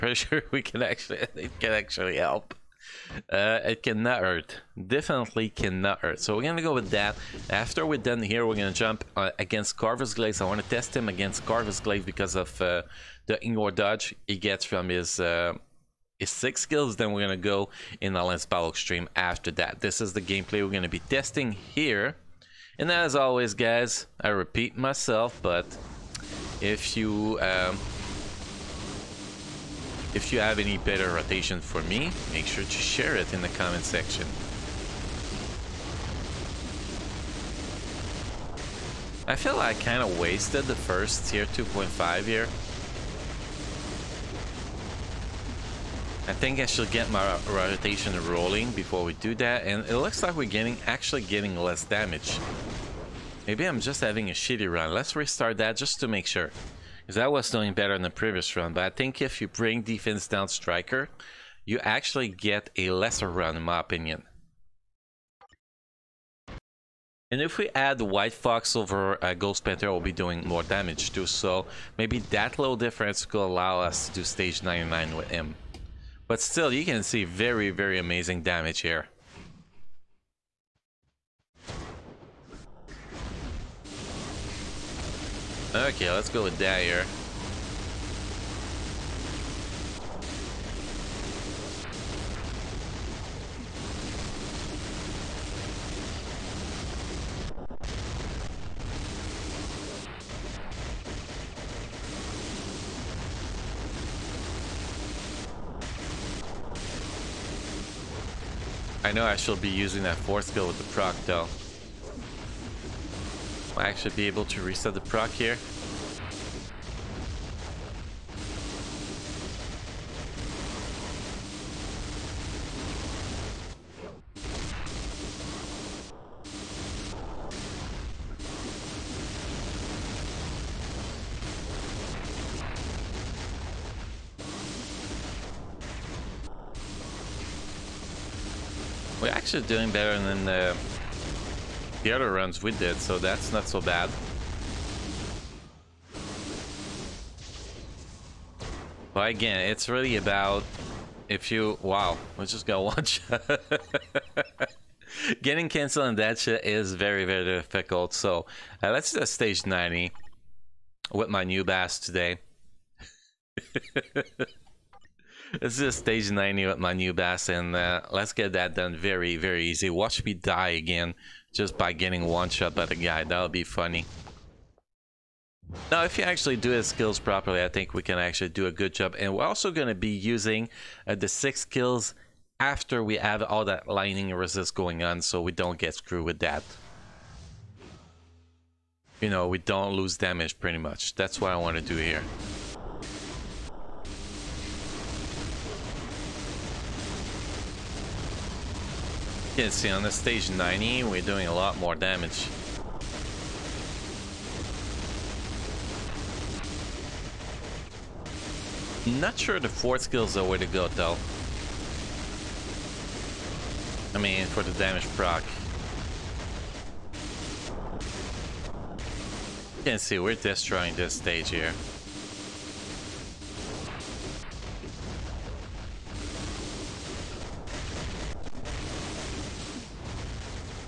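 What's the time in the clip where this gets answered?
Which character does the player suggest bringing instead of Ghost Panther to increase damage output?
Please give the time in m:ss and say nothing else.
1:07.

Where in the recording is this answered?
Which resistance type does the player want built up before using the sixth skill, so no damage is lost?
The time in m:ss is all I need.
3:03.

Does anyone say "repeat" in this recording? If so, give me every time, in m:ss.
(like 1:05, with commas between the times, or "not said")
0:24.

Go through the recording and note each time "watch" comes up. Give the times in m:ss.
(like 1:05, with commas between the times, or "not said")
2:32, 2:49.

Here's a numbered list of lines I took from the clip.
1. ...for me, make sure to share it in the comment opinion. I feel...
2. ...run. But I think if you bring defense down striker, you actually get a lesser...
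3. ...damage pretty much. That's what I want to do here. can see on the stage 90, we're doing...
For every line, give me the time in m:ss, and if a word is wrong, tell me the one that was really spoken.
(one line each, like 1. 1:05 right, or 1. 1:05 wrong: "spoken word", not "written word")
1. 0:31 wrong: "section", not "opinion"
2. 0:58 right
3. 3:10 right.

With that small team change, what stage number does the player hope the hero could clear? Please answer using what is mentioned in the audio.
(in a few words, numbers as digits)
99.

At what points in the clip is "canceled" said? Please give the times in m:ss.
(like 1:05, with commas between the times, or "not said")
2:35.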